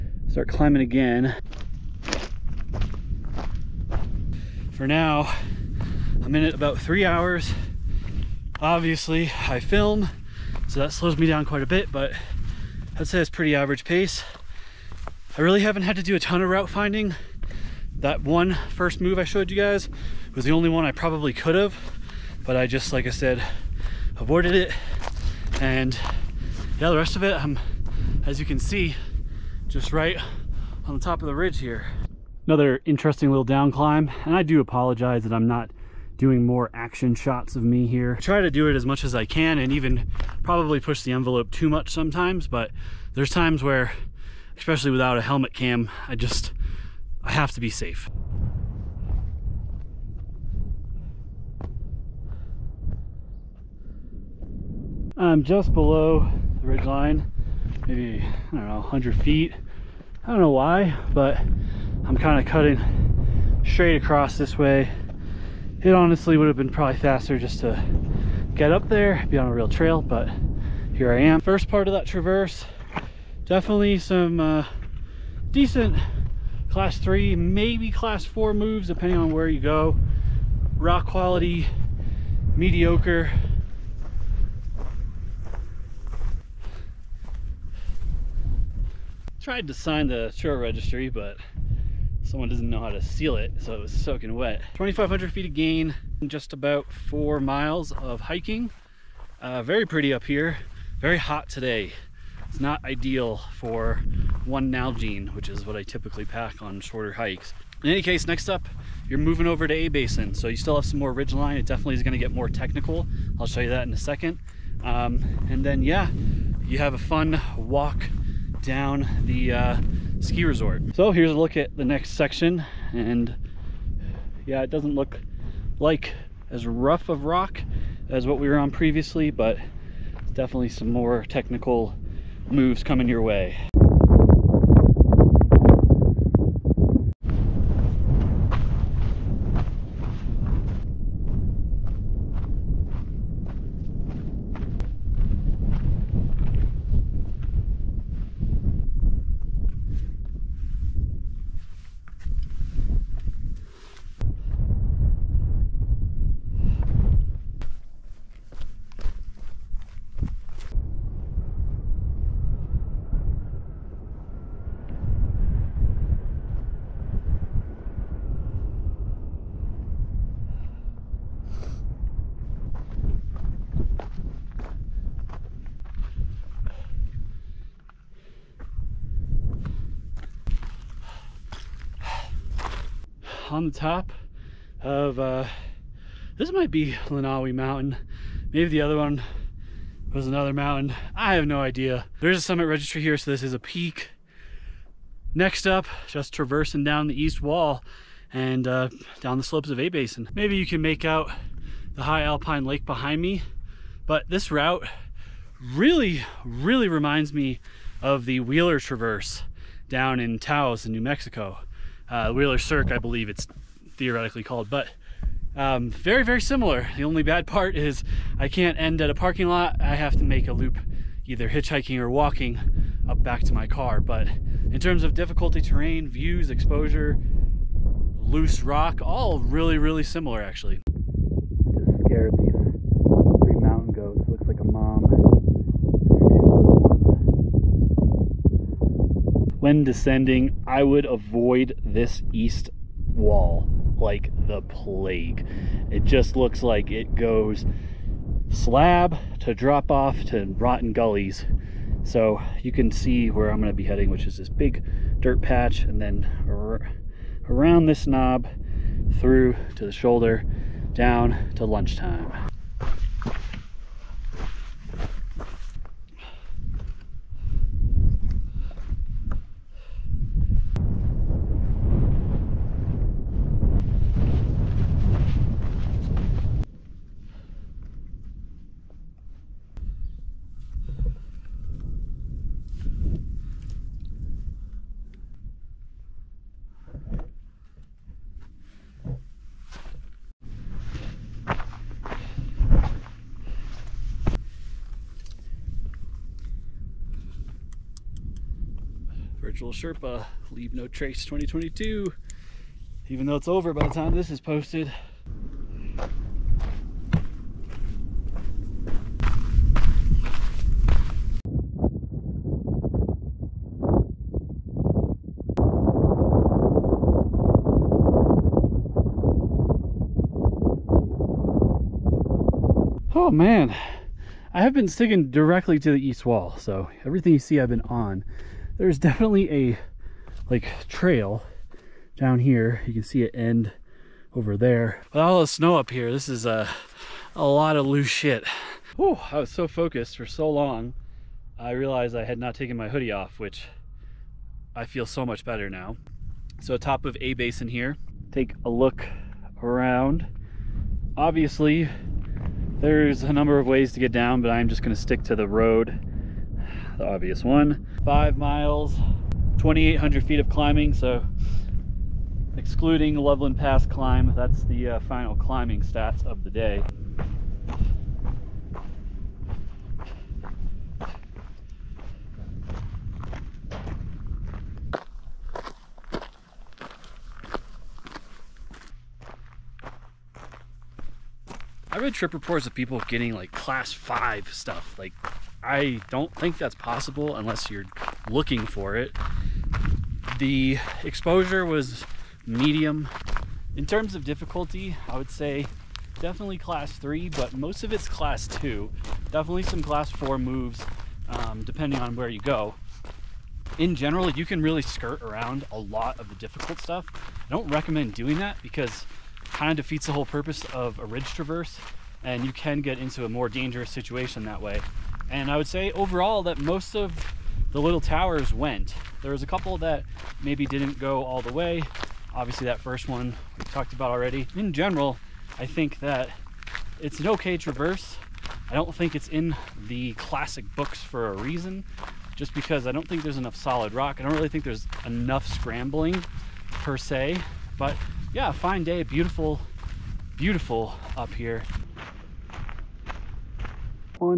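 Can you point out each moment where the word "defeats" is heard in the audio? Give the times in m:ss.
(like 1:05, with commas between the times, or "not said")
6:49.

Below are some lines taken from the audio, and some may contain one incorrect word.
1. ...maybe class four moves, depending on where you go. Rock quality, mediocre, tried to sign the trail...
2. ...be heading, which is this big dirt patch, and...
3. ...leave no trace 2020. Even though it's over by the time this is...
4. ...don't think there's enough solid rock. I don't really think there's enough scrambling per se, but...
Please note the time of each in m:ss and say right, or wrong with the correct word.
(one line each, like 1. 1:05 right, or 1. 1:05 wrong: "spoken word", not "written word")
1. 1:17 right
2. 4:13 right
3. 5:00 wrong: "2022", not "2020"
4. 7:12 right.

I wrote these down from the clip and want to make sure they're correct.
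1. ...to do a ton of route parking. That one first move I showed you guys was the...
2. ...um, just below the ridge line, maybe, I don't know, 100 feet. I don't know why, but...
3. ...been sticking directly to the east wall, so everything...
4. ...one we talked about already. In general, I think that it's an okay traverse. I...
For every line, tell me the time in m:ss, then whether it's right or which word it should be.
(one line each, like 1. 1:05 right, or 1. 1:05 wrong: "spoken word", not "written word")
1. 0:15 wrong: "finding", not "parking"
2. 0:55 right
3. 5:24 right
4. 7:03 right.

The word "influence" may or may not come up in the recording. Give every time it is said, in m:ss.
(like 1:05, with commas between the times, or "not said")
not said.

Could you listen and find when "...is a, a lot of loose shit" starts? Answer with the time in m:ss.
5:36.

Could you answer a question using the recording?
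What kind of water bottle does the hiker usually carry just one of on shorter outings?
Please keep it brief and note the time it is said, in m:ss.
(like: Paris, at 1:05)
Nalgene, at 1:44.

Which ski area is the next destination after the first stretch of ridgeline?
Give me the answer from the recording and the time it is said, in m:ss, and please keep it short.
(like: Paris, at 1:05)
A-Basin, at 1:49.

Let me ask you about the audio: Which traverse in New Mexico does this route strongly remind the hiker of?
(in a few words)
Wheeler Traverse.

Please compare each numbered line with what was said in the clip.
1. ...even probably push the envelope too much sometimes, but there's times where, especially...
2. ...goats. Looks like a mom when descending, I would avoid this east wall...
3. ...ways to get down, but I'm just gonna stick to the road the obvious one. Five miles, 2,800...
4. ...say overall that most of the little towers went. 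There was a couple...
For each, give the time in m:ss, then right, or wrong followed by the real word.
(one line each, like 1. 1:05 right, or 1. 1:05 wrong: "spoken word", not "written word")
1. 0:39 right
2. 3:53 right
3. 5:53 right
4. 6:55 right.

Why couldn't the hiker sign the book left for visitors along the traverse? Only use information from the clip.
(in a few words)
It was soaking wet.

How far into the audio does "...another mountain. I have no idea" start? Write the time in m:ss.
3:10.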